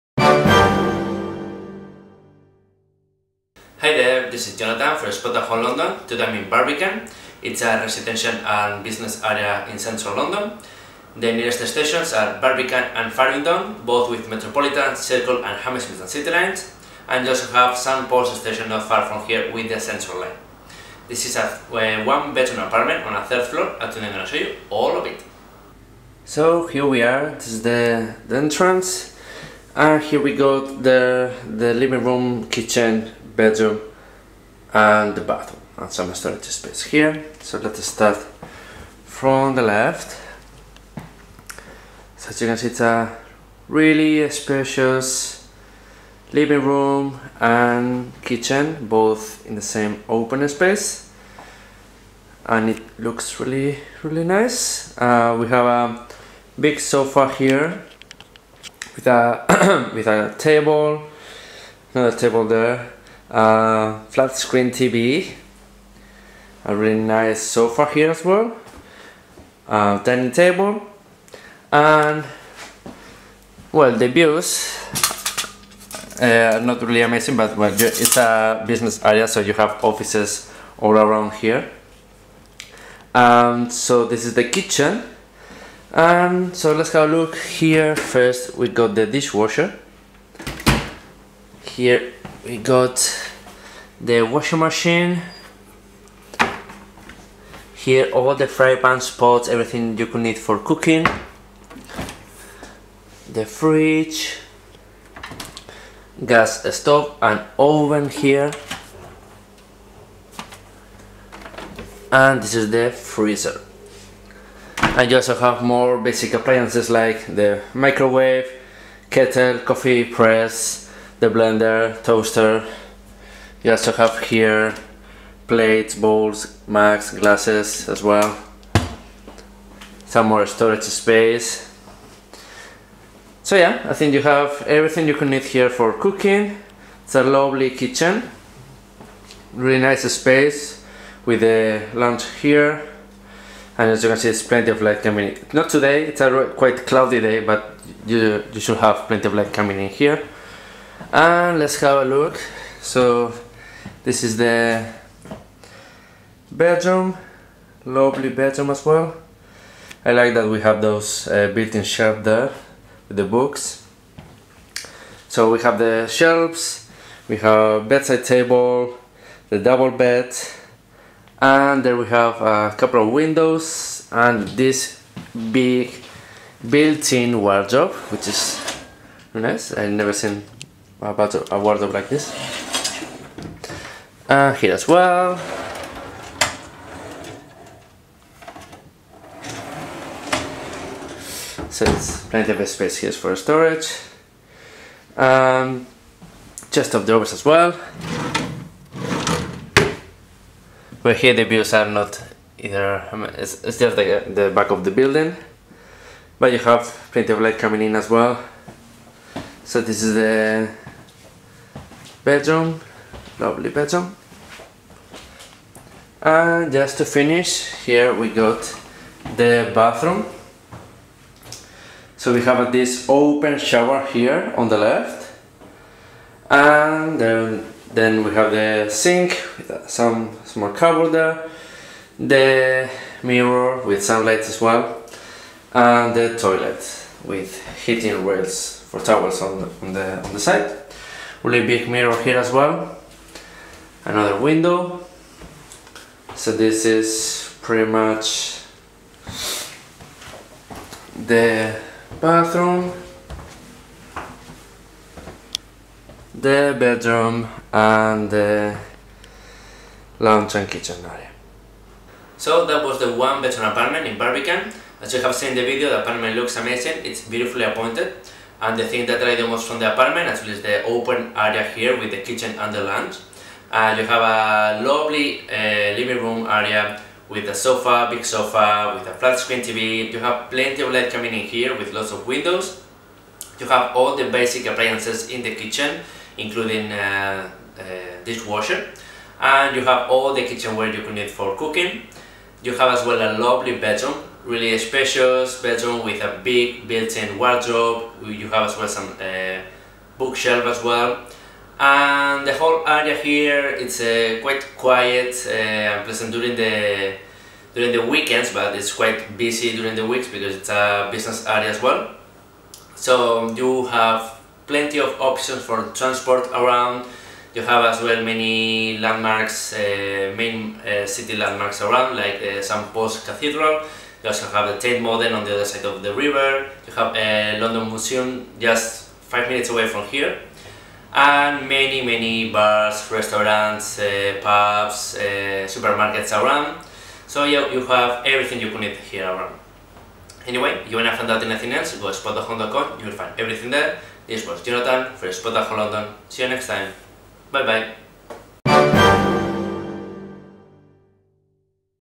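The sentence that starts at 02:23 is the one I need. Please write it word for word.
And as you can see, it's plenty of light coming in.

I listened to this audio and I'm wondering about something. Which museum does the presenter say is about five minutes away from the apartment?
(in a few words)
London Museum.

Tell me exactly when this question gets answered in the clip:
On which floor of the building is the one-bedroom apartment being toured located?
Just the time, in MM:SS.
00:23.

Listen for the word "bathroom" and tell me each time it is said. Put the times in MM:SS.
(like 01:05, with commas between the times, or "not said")
00:35, 03:39, 04:12.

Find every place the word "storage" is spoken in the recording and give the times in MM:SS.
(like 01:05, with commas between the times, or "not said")
00:36, 02:10, 03:13.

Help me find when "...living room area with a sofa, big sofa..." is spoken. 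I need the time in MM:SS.
04:36.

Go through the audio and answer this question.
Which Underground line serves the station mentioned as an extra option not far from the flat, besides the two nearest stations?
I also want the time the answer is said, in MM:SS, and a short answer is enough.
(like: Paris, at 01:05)
Central line, at 00:19.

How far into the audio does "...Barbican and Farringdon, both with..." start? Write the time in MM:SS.
00:12.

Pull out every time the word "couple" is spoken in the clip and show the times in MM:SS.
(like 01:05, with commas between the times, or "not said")
02:52.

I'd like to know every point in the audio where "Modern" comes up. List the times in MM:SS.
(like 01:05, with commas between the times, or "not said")
05:25.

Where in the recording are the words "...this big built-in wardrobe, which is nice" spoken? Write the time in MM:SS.
02:54.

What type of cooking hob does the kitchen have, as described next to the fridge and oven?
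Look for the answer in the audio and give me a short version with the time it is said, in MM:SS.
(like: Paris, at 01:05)
Gas stove, at 01:46.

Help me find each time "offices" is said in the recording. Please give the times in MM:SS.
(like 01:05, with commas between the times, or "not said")
01:19.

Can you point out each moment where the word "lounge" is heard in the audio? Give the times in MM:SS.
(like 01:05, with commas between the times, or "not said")
02:21, 04:20, 04:32.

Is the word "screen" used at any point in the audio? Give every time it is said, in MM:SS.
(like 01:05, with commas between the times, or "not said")
01:04, 04:39.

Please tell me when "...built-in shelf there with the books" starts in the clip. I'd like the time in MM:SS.
02:41.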